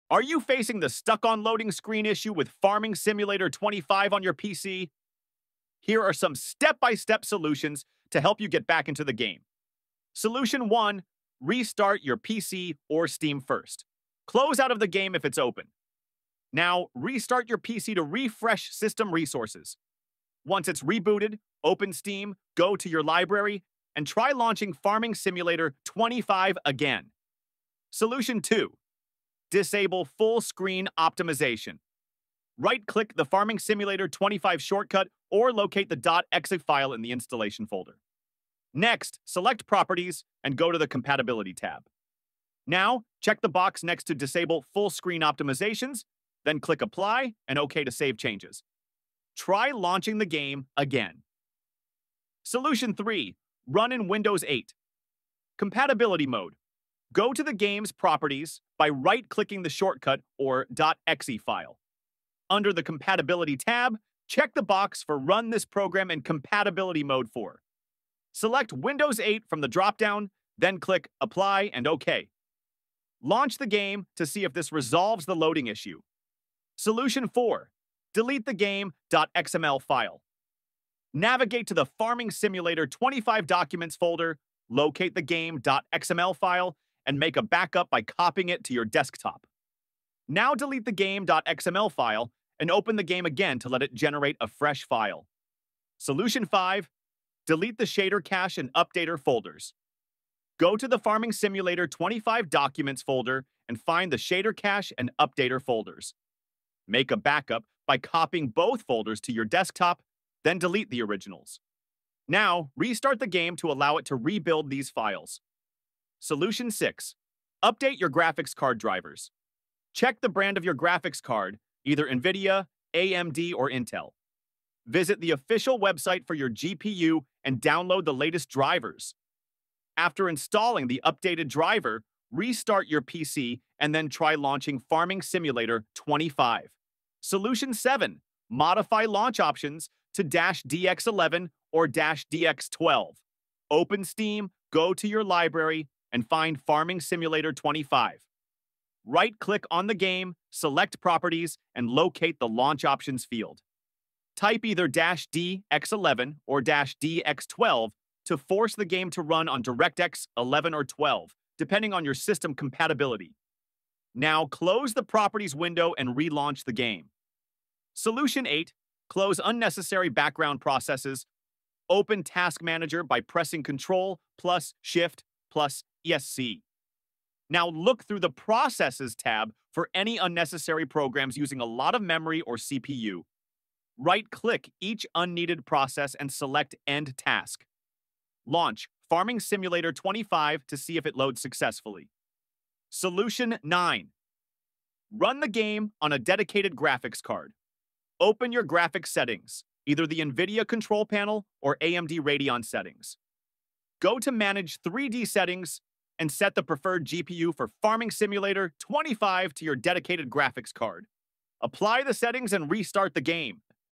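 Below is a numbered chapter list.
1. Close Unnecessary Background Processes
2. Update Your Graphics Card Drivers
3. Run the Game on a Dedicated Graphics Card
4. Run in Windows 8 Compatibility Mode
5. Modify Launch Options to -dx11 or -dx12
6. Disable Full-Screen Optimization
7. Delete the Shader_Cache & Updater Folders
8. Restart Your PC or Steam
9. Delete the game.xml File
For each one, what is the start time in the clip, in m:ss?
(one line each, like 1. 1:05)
1. 2:48
2. 2:18
3. 3:13
4. 0:53
5. 1:57
6. 0:28
7. 1:36
8. 0:11
9. 1:17.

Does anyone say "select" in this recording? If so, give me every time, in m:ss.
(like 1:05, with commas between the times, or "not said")
0:39, 1:08, 2:30, 3:06.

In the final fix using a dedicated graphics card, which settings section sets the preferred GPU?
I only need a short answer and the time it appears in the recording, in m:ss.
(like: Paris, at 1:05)
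Manage 3D Settings, at 3:24.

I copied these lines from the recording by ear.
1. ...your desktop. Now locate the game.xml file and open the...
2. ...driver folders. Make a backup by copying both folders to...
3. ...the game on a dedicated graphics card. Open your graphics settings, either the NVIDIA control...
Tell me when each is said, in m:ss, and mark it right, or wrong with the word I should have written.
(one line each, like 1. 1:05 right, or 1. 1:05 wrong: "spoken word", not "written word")
1. 1:28 wrong: "delete", not "locate"
2. 1:45 wrong: "updater", not "driver"
3. 3:15 right.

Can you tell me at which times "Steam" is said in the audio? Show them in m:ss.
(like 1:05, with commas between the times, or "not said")
0:13, 0:21, 2:24.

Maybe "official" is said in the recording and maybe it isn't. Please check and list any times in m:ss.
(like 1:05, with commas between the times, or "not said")
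2:05.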